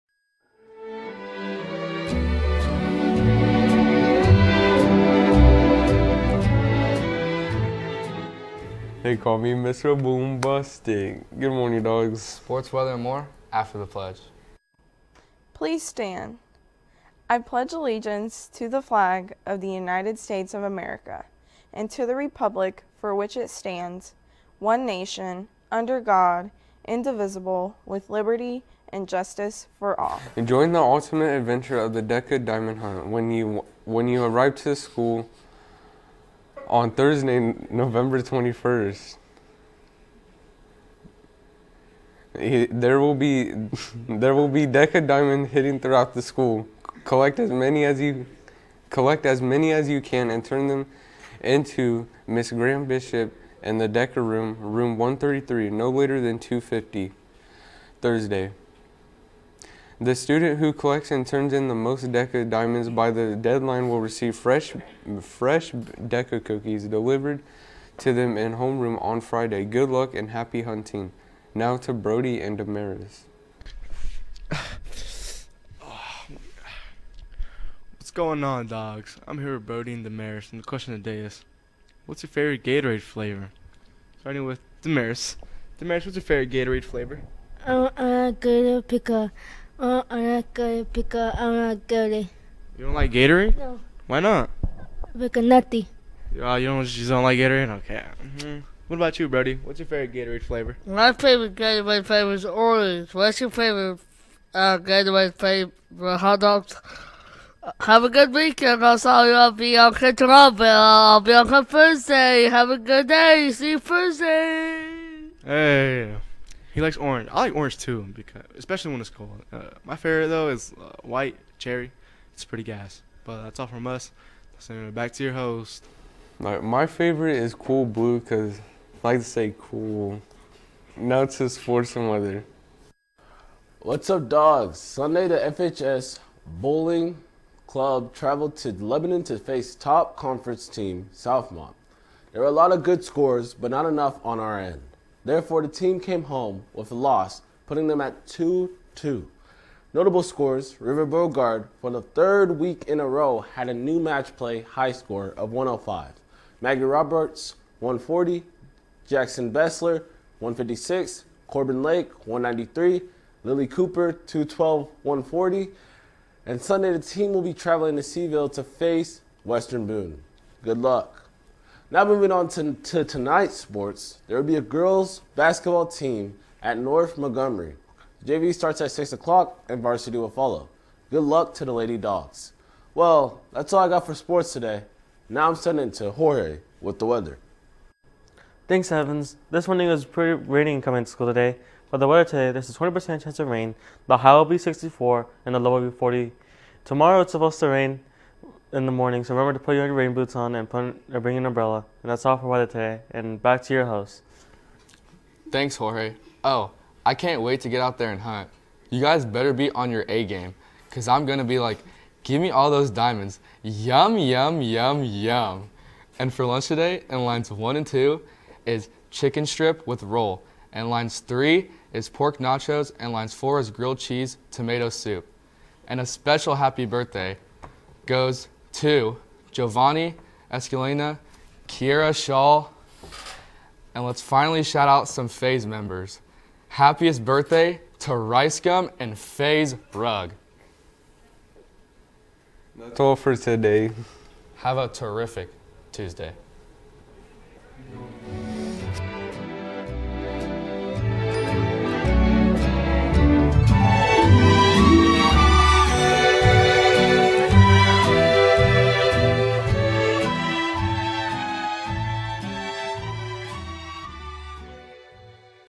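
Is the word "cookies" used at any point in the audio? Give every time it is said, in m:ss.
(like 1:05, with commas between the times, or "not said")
1:06.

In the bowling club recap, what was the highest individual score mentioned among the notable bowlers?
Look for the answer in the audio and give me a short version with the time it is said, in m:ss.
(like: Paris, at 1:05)
212, at 2:44.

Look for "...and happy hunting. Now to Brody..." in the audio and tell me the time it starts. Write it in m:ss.
1:10.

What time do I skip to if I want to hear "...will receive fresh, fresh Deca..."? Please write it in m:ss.
1:03.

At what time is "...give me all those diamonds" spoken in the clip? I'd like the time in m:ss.
3:32.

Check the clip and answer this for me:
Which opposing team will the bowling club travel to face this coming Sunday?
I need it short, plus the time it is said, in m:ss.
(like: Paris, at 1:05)
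Western Boone, at 2:49.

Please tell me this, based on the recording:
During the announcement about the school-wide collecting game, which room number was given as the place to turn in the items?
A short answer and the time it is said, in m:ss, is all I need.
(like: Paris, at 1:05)
133, at 0:54.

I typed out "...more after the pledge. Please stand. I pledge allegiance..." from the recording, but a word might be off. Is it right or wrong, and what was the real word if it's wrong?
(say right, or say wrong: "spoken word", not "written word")
right.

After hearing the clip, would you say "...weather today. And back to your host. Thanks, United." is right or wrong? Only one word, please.
wrong.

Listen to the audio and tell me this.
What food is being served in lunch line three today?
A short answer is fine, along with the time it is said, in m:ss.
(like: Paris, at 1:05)
Pork nachos, at 3:42.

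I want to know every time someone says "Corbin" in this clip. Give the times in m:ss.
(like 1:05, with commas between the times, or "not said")
2:41.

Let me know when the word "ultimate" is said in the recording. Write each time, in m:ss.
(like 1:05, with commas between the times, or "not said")
0:30.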